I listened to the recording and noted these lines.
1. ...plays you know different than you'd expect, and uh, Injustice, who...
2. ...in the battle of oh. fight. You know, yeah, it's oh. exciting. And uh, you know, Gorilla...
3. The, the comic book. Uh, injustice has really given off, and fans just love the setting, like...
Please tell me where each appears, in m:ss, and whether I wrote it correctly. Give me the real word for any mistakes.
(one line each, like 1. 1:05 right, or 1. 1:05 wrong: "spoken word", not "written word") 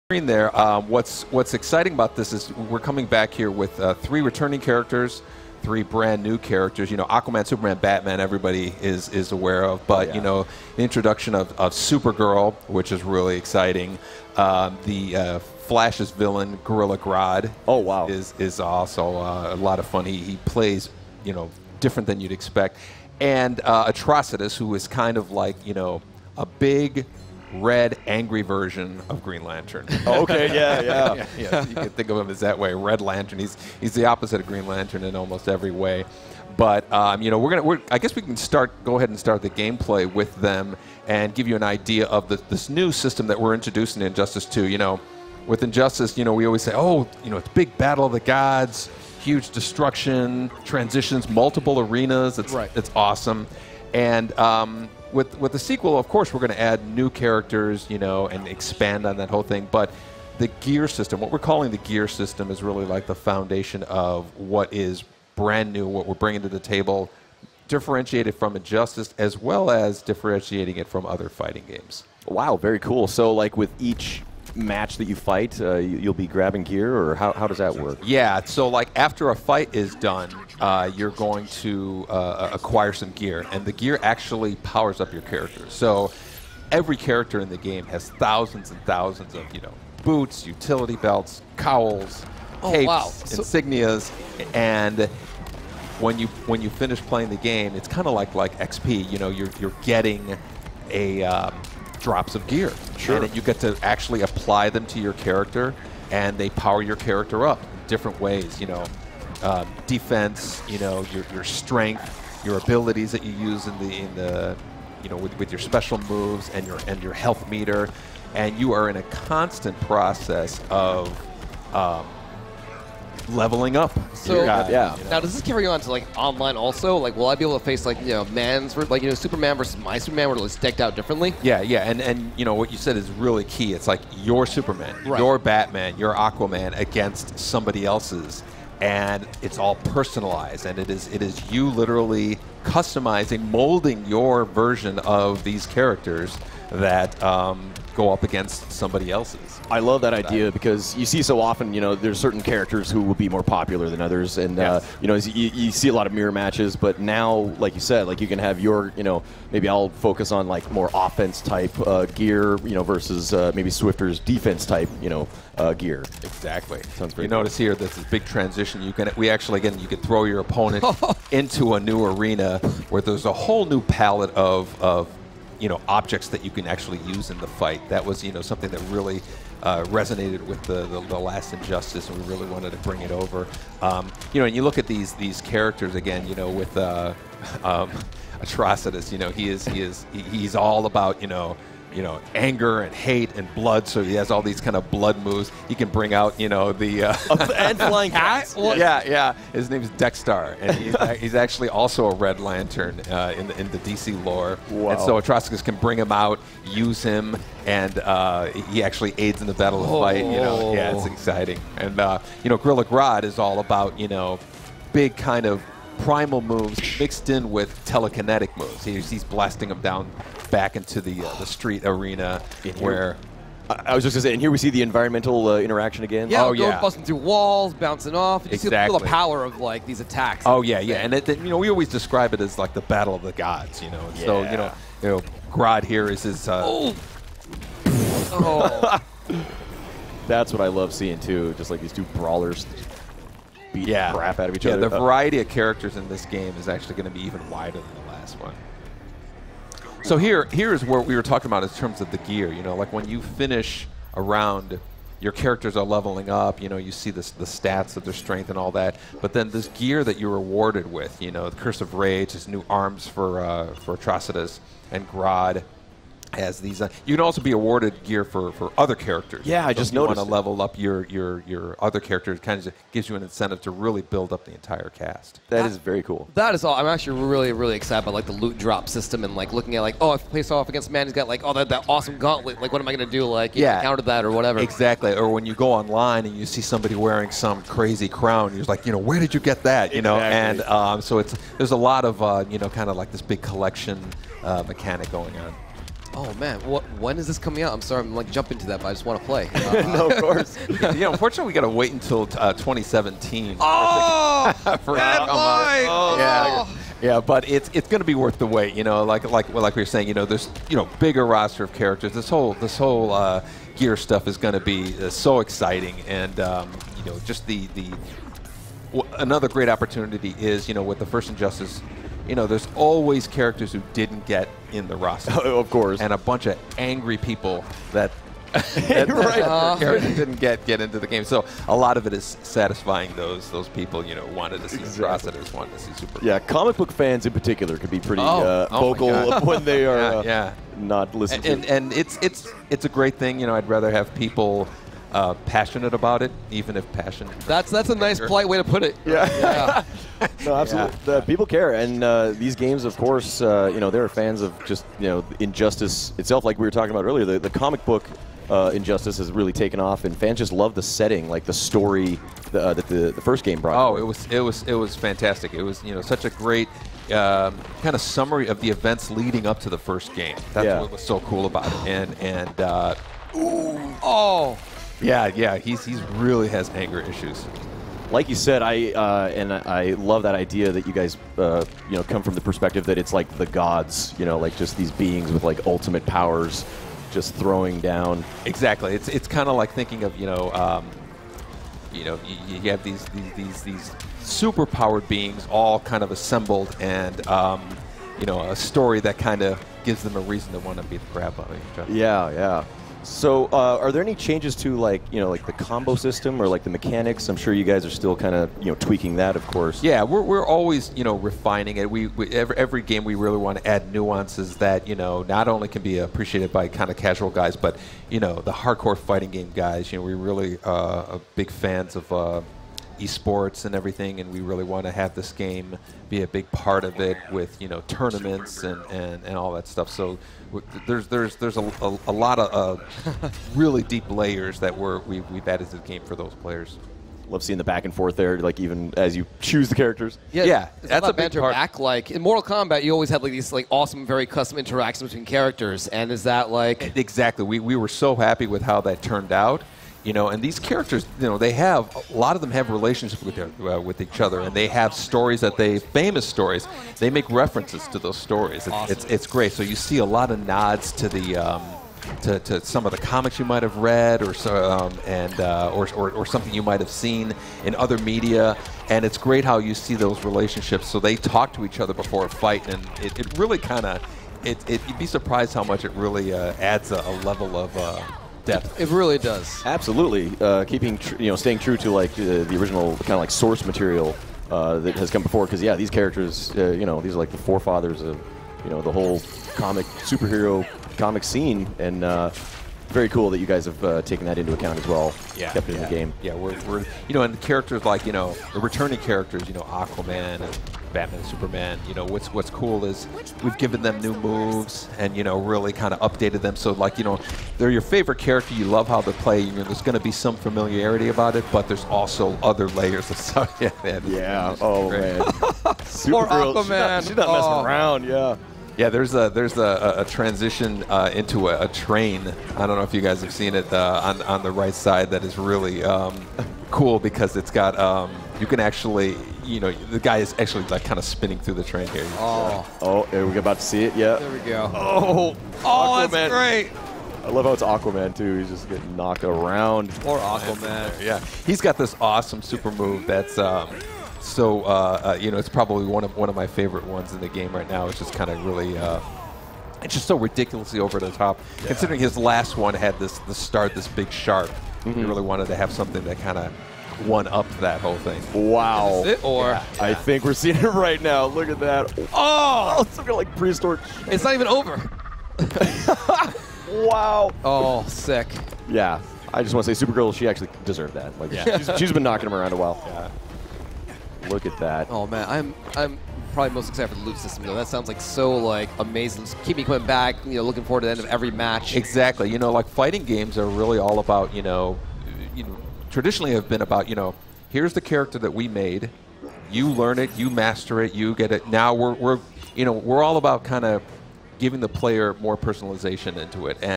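1. 0:20 wrong: "Atrocitus", not "Injustice"
2. 3:29 right
3. 5:57 wrong: "taken", not "given".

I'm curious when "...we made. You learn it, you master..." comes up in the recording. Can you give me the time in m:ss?
9:48.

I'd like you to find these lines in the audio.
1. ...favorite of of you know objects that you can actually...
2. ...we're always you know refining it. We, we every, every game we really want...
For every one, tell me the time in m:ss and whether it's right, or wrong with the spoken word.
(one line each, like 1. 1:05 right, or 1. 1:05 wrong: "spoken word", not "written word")
1. 2:53 wrong: "palette", not "favorite"
2. 6:50 right.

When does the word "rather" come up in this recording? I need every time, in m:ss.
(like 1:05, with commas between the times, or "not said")
5:43.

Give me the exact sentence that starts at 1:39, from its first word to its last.
You know, you're you're getting a um, drops of gear.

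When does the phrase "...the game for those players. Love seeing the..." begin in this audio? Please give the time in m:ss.
7:15.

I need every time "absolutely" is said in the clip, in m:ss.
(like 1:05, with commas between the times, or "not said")
5:50, 7:59.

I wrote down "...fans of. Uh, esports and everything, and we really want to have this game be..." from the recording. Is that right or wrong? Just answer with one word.
right.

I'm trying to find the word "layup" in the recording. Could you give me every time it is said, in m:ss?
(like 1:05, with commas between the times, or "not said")
not said.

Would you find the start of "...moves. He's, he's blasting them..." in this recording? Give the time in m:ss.
3:38.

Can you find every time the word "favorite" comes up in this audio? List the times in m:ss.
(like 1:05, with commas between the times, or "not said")
8:27, 9:06.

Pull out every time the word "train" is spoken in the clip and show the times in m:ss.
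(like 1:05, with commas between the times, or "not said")
8:41, 8:51.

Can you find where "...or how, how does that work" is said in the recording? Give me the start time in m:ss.
1:16.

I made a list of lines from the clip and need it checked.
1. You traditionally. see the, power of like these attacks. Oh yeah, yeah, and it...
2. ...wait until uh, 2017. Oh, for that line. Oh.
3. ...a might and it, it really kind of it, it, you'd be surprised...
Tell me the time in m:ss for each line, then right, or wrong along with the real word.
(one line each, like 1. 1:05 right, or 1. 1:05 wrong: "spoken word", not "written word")
1. 3:48 wrong: "exactly", not "traditionally"
2. 5:01 right
3. 7:52 wrong: "fight", not "might".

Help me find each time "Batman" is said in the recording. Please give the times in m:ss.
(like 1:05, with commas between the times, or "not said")
0:07, 2:15, 8:20.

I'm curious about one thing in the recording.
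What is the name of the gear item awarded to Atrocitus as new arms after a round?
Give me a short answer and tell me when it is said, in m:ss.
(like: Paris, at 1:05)
Curse of Rage, at 4:21.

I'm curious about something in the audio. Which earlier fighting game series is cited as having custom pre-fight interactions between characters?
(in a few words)
Mortal Kombat.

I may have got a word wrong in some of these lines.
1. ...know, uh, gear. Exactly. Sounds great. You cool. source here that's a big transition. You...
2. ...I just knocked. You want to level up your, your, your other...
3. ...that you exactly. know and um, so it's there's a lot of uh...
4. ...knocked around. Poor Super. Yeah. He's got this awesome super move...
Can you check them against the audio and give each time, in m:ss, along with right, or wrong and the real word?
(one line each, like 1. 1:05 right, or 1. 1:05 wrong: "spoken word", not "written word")
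1. 2:45 wrong: "notice", not "source"
2. 4:29 wrong: "noticed", not "knocked"
3. 4:49 right
4. 8:58 wrong: "Aquaman", not "Super".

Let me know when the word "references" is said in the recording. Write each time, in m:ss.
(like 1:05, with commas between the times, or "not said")
7:37.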